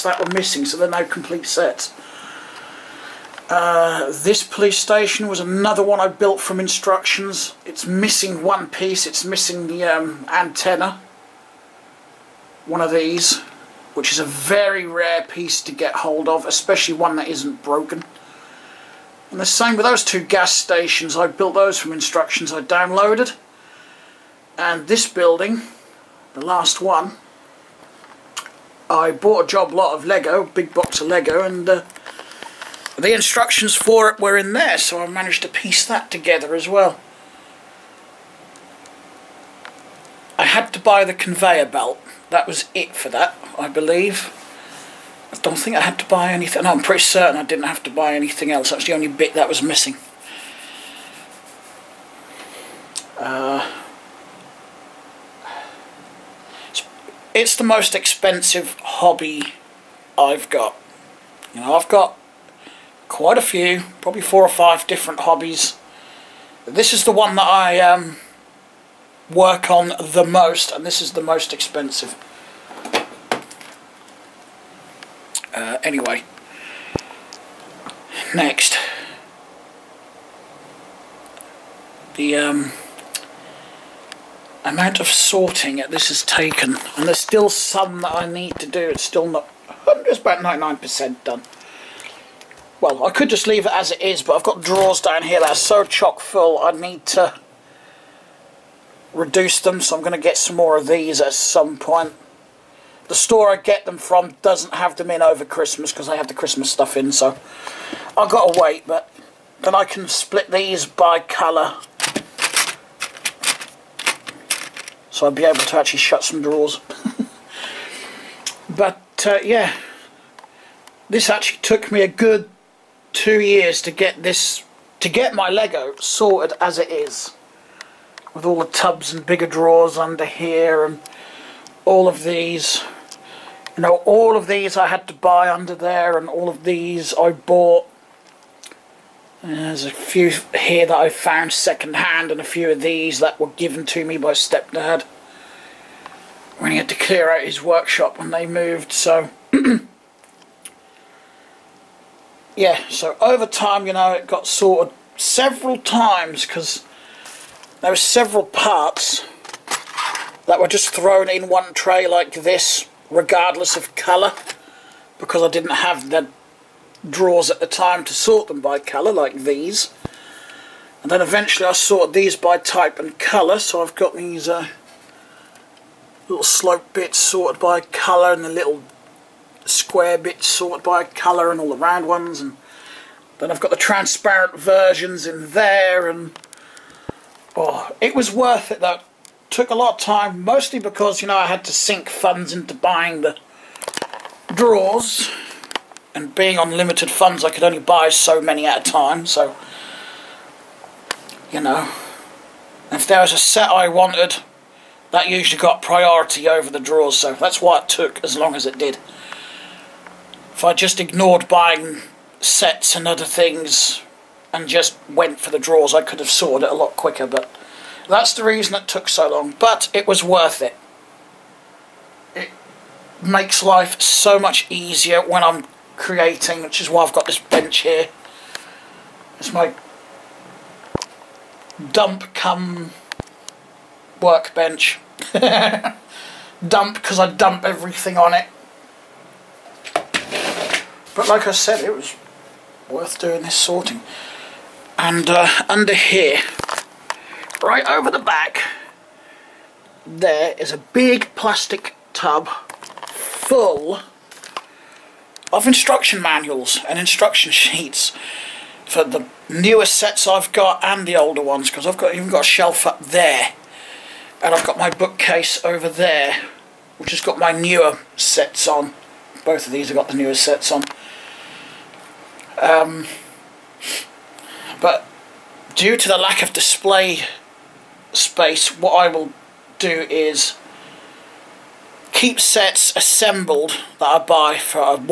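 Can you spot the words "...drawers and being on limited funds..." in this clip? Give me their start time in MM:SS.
03:14.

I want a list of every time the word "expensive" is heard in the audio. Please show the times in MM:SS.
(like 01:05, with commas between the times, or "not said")
00:57, 01:11.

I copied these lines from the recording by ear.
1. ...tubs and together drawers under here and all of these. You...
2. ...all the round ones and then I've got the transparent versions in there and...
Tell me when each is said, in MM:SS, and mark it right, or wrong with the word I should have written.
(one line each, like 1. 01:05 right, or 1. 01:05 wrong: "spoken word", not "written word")
1. 02:08 wrong: "bigger", not "together"
2. 03:01 right.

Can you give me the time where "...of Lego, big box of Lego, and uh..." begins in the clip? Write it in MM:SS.
00:29.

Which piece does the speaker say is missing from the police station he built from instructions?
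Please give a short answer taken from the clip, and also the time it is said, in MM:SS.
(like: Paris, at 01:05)
antenna, at 00:10.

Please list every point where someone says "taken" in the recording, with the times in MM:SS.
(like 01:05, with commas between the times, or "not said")
01:26.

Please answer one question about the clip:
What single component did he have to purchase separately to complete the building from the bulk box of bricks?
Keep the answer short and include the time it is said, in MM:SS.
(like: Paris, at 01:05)
conveyor belt, at 00:41.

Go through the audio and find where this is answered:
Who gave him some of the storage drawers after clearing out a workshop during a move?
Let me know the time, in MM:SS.
02:24.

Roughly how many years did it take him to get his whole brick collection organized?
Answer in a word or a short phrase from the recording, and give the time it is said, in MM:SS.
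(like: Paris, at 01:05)
2, at 02:03.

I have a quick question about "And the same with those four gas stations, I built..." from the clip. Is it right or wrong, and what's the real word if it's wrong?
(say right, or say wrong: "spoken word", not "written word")
wrong: "two", not "four".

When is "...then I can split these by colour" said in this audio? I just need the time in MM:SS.
01:49.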